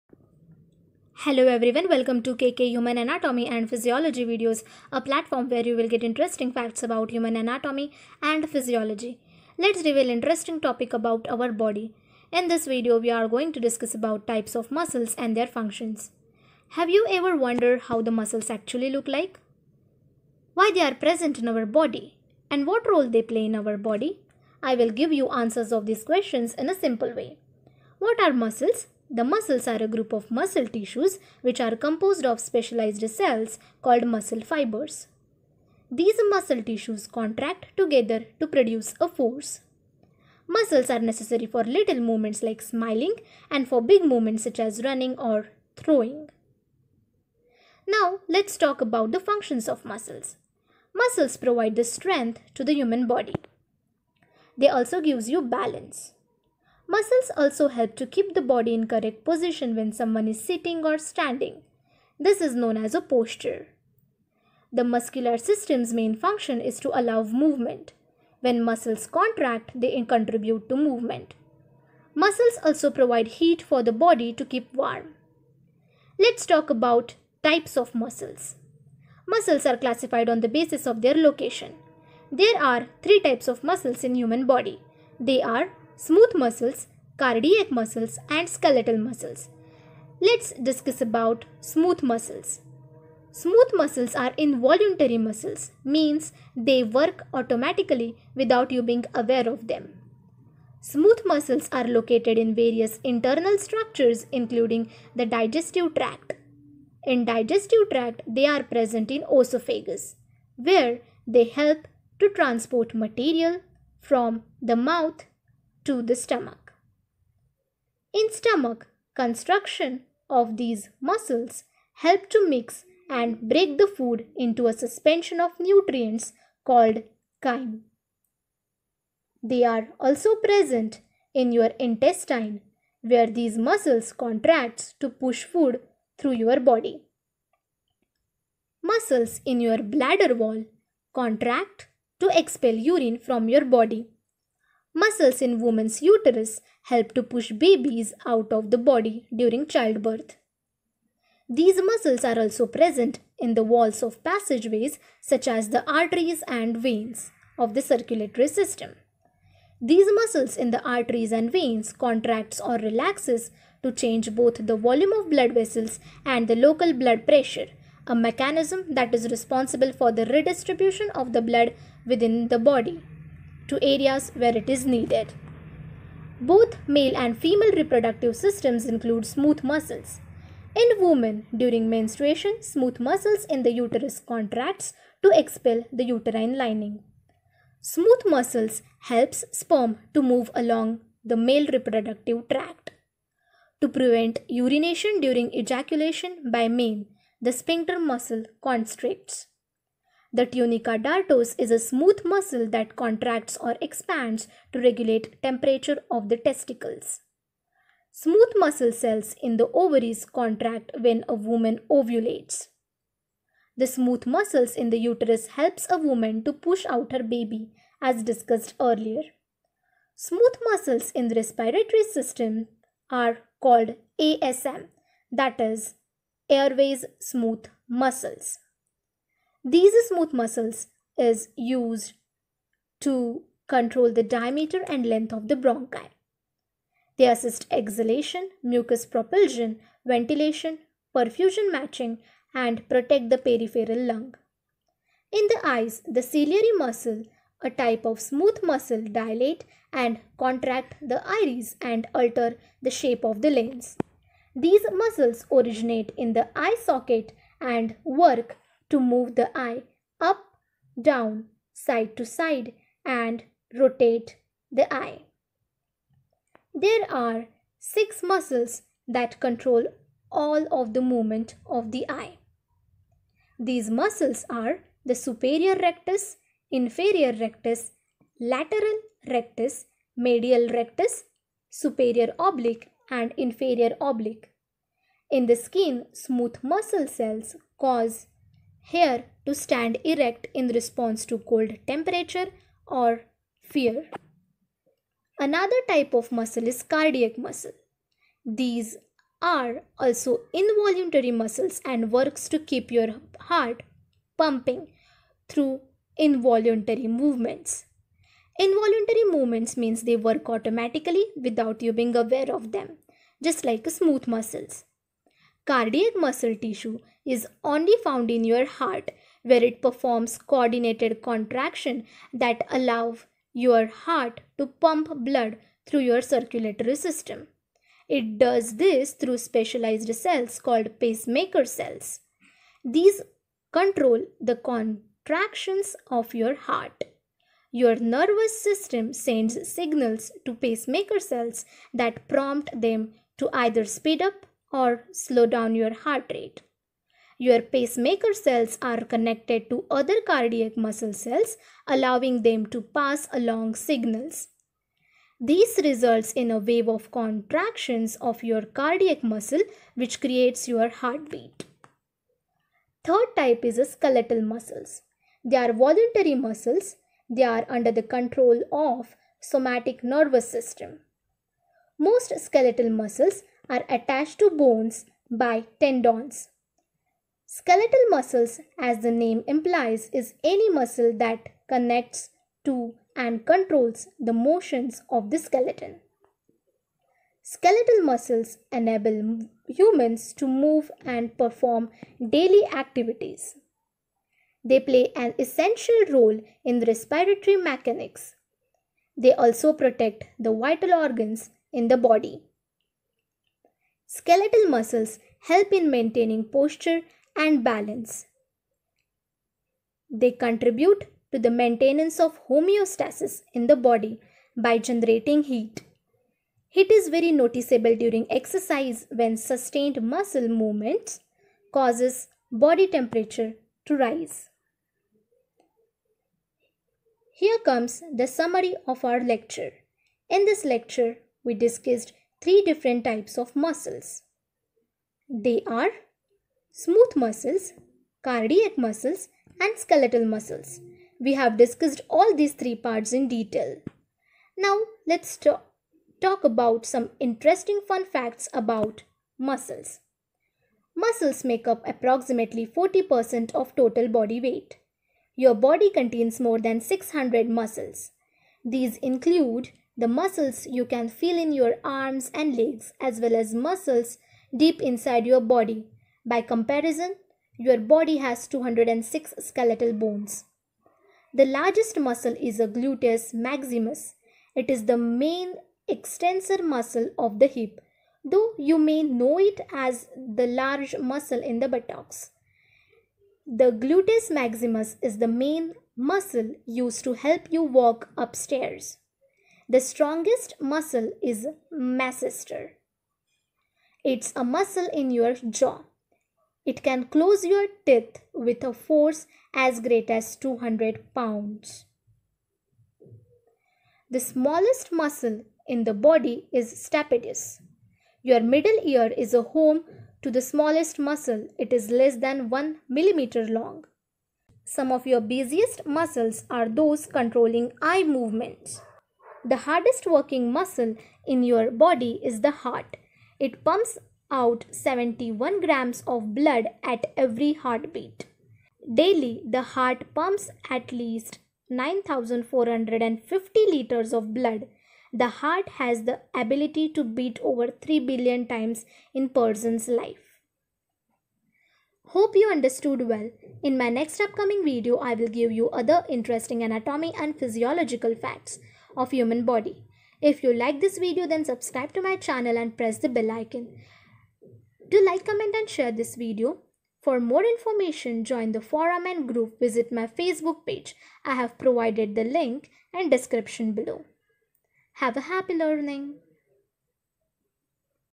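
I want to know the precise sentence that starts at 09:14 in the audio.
Do like, comment and share this video.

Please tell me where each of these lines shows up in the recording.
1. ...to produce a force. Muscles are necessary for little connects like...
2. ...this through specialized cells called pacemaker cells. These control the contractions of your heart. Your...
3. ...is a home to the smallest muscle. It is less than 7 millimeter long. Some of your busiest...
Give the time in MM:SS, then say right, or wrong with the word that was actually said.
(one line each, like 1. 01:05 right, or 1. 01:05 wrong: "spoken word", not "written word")
1. 00:38 wrong: "movements", not "connects"
2. 05:28 right
3. 08:29 wrong: "1", not "7".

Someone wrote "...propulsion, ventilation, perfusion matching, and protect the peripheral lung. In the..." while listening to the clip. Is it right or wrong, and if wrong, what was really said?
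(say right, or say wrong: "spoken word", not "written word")
right.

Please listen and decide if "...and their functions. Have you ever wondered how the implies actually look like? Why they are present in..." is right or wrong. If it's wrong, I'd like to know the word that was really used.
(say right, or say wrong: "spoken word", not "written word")
wrong: "muscles", not "implies".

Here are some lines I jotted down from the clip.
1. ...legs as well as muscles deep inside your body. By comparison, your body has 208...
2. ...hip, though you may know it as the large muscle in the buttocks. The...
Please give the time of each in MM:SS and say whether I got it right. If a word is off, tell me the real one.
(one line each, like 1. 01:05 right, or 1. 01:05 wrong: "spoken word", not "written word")
1. 07:42 wrong: "206", not "208"
2. 07:57 right.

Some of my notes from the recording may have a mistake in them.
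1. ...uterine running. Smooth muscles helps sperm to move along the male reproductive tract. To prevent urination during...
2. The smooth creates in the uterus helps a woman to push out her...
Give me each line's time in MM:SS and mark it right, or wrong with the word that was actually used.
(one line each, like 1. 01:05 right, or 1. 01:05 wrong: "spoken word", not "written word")
1. 03:06 wrong: "lining", not "running"
2. 03:33 wrong: "muscles", not "creates".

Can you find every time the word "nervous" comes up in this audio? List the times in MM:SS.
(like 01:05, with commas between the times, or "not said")
05:37, 06:10.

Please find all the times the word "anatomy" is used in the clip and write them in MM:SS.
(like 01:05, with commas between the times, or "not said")
00:02, 00:07, 09:06.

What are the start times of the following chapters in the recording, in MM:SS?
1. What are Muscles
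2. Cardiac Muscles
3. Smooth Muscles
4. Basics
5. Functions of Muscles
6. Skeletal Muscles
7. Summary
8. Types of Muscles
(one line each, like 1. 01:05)
1. 00:24
2. 04:56
3. 01:31
4. 00:14
5. 00:49
6. 06:03
7. 07:06
8. 01:17.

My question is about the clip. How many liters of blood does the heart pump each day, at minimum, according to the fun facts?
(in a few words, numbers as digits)
9450 liters.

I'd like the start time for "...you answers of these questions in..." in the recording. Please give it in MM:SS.
00:25.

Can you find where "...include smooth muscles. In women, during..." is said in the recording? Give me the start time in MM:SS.
02:58.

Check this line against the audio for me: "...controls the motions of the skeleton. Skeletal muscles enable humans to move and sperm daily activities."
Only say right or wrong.
wrong.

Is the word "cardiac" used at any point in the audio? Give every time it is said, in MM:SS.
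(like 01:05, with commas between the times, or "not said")
01:27, 04:56, 05:15, 05:50, 05:58, 07:18.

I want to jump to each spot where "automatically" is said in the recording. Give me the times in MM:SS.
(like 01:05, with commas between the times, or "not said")
01:37, 05:10.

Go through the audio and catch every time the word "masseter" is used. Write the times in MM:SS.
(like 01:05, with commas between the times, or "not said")
08:11.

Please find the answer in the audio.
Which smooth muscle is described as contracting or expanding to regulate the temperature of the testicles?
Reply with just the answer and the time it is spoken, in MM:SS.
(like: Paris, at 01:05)
tunica dartos, at 03:20.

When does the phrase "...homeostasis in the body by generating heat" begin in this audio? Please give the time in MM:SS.
06:52.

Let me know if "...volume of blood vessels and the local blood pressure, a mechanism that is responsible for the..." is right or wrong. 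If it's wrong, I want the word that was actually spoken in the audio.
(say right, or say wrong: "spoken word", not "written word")
right.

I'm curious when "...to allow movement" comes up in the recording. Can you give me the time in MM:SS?
01:06.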